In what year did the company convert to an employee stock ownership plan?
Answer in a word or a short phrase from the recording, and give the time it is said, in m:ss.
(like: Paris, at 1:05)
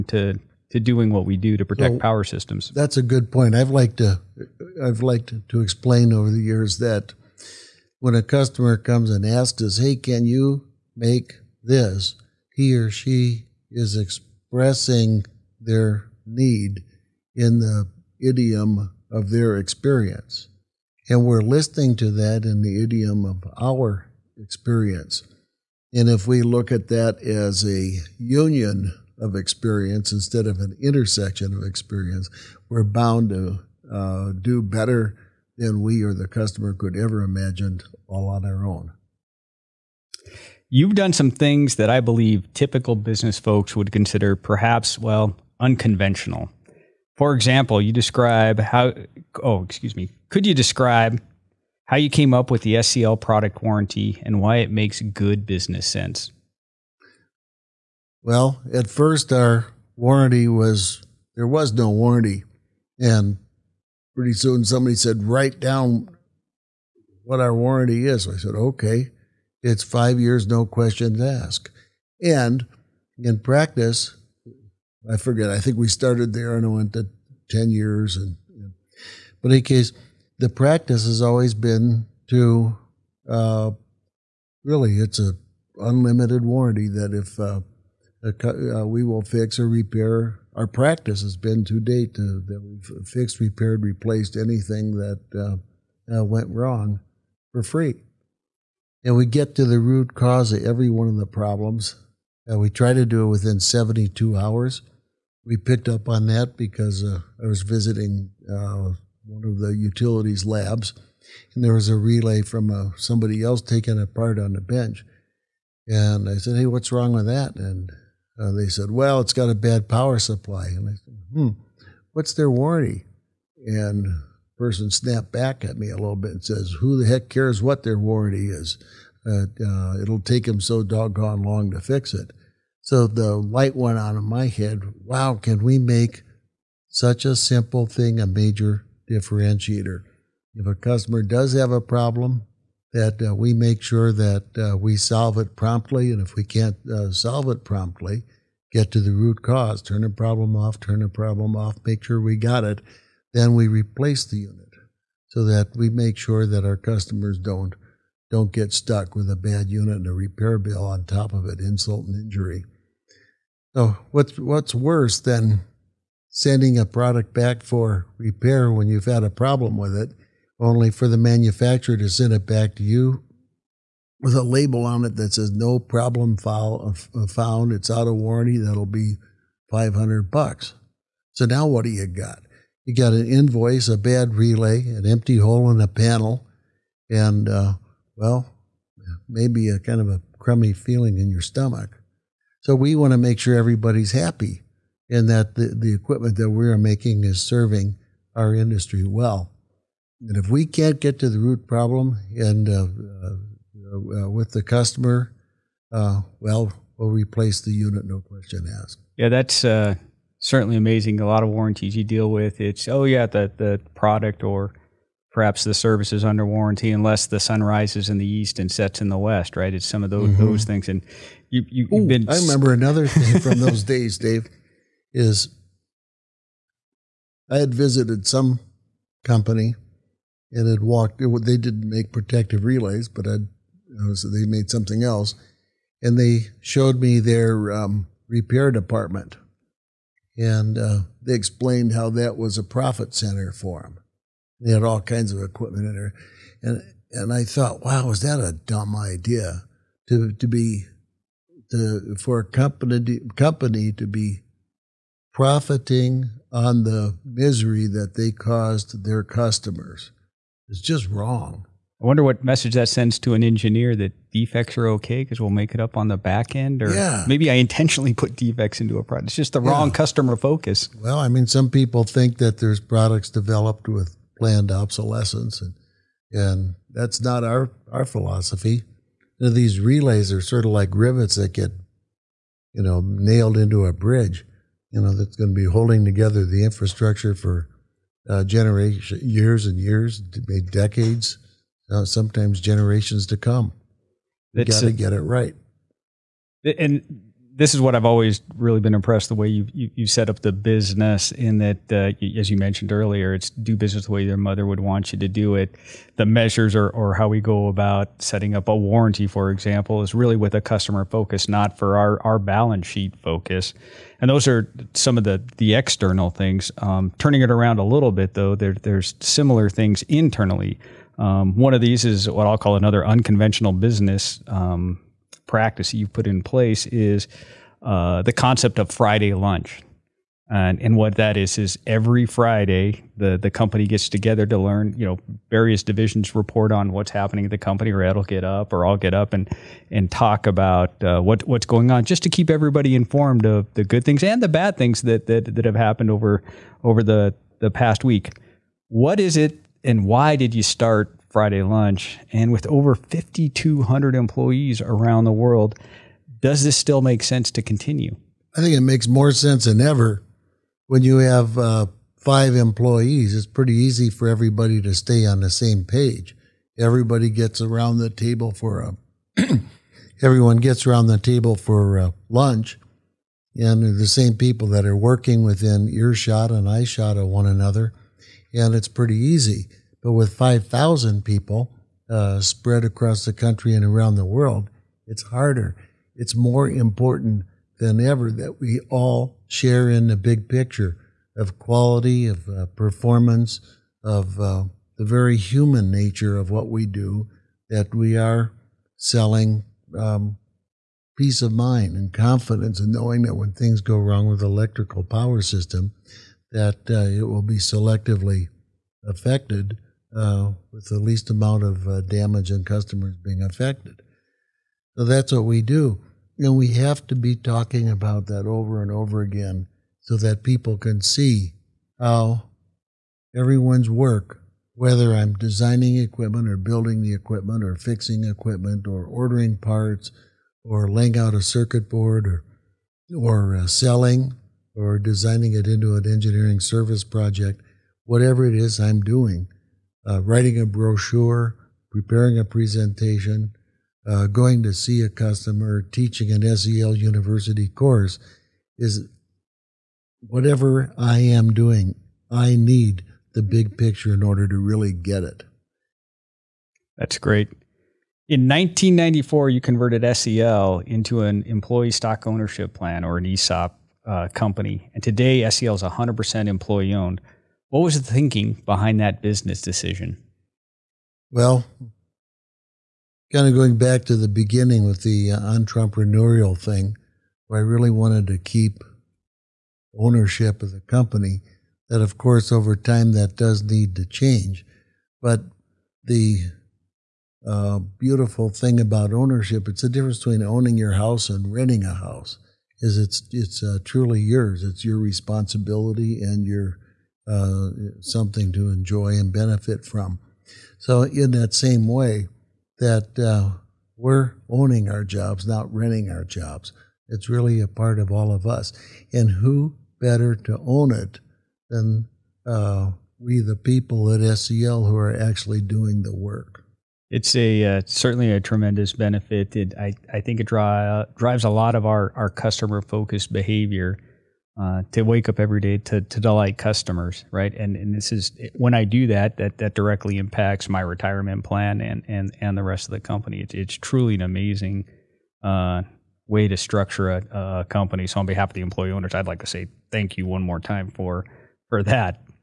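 1994, at 7:38.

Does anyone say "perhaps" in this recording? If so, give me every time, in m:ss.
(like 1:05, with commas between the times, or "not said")
0:44, 3:35.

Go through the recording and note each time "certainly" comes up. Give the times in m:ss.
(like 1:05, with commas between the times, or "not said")
3:30, 8:37.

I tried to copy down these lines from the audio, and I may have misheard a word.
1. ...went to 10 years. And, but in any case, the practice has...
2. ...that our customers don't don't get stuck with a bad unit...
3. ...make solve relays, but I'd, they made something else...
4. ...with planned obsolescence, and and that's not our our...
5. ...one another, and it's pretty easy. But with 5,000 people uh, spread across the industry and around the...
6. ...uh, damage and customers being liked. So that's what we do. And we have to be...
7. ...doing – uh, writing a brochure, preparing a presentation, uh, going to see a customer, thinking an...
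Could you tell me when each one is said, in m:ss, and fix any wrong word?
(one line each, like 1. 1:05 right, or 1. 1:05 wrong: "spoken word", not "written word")
1. 1:16 right
2. 2:36 right
3. 3:51 wrong: "protective", not "solve"
4. 4:33 right
5. 6:17 wrong: "country", not "industry"
6. 6:51 wrong: "affected", not "liked"
7. 7:18 wrong: "teaching", not "thinking".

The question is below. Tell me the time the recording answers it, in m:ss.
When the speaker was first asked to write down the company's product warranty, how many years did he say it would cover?
1:09.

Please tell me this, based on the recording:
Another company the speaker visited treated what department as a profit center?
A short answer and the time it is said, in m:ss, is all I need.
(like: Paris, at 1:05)
repair department, at 3:58.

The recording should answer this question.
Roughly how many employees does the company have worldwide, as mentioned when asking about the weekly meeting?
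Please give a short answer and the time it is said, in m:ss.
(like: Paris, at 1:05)
5,200, at 5:52.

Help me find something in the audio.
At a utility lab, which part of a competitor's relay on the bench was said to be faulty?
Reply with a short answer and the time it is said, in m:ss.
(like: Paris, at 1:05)
power supply, at 1:59.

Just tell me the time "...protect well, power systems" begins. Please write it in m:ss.
0:01.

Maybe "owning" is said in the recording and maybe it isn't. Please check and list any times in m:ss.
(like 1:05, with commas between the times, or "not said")
8:10, 8:24.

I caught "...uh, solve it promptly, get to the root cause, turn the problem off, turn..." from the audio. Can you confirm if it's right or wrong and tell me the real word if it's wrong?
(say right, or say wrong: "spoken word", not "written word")
right.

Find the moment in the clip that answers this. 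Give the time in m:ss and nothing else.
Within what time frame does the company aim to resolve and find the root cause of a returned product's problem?
1:43.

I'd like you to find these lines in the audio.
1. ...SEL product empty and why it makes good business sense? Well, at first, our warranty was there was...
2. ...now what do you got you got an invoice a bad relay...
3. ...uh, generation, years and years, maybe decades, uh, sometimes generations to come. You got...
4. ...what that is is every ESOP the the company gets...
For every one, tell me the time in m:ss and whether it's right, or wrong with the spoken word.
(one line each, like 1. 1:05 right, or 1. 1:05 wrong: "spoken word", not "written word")
1. 0:52 wrong: "warranty", not "empty"
2. 3:01 right
3. 4:48 right
4. 5:30 wrong: "Friday", not "ESOP".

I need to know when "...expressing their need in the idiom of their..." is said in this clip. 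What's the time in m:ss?
0:13.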